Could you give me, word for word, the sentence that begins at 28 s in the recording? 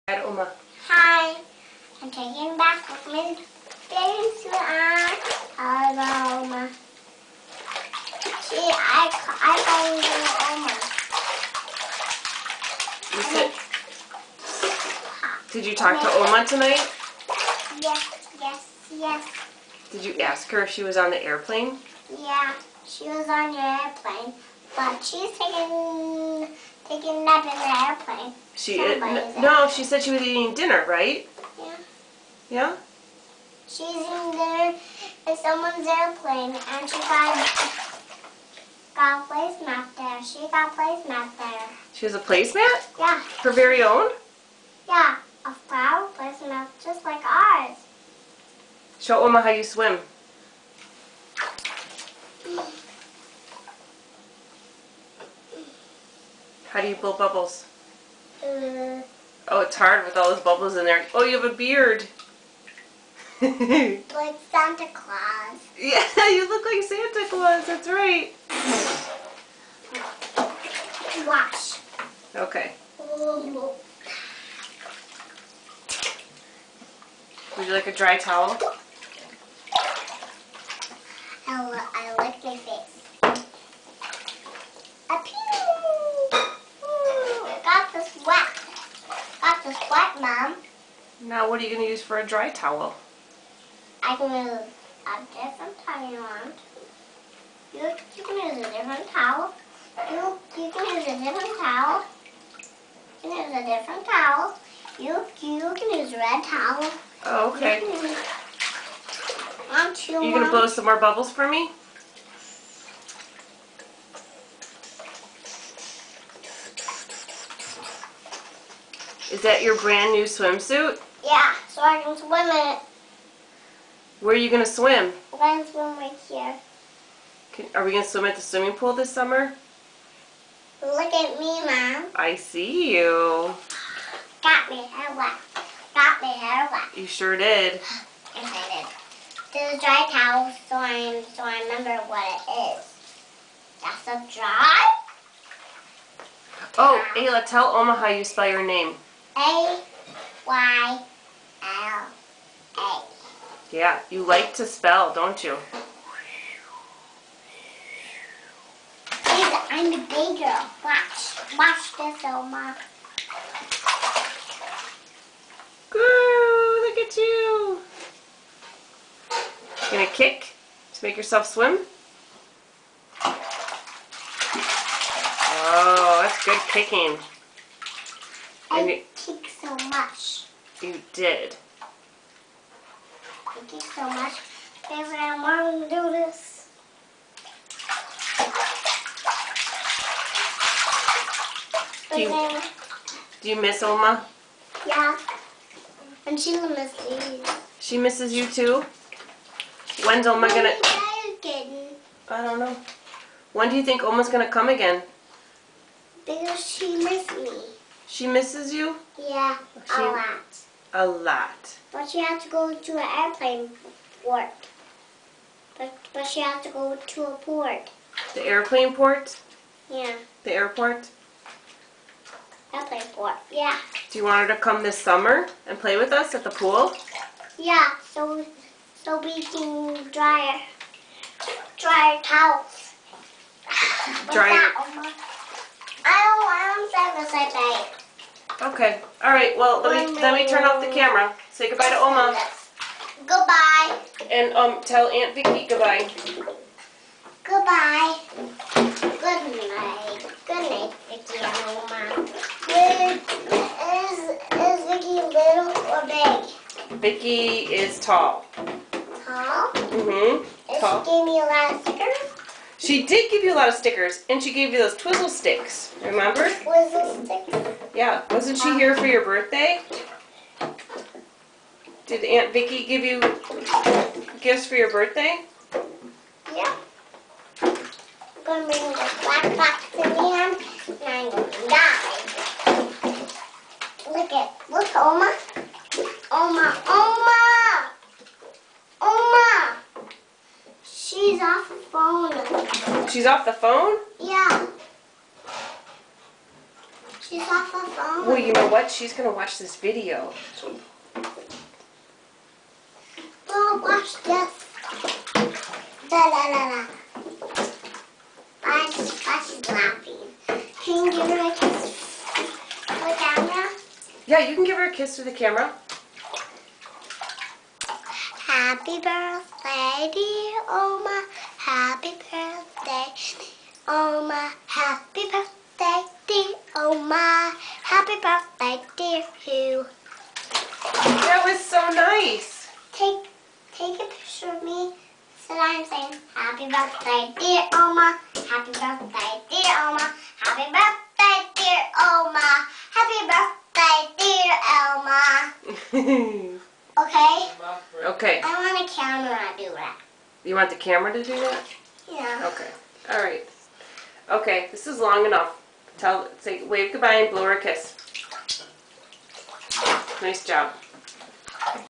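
She uh, no, she said she was eating dinner, right?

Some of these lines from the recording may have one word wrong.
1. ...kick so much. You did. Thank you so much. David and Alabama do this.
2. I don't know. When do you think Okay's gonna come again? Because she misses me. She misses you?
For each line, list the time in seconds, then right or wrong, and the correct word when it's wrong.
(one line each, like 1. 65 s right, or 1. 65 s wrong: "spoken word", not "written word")
1. 179 s wrong: "Mom", not "Alabama"
2. 200 s wrong: "Oma", not "Okay".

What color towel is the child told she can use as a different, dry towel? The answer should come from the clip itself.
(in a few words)
Red.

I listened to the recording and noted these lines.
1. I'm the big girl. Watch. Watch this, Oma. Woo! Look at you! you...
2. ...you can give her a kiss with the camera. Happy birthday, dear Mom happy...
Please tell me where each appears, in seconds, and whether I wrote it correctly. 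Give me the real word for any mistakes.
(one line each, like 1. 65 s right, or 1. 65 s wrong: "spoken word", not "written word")
1. 159 s right
2. 314 s wrong: "Oma", not "Mom".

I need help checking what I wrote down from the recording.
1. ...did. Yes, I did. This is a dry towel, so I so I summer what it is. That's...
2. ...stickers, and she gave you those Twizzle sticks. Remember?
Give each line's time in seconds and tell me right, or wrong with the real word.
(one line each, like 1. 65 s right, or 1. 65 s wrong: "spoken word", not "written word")
1. 137 s wrong: "remember", not "summer"
2. 263 s right.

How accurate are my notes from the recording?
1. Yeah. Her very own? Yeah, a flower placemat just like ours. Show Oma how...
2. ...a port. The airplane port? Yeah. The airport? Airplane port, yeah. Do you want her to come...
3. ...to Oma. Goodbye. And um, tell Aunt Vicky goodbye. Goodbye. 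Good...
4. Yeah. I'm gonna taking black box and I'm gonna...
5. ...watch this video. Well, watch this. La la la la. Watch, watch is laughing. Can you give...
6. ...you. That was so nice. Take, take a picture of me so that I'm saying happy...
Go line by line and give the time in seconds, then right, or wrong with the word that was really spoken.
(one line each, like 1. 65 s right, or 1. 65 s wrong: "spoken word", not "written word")
1. 42 s right
2. 217 s right
3. 241 s right
4. 276 s wrong: "bring", not "taking"
5. 299 s right
6. 329 s right.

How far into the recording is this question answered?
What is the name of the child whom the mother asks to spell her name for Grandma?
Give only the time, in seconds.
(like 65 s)
147 s.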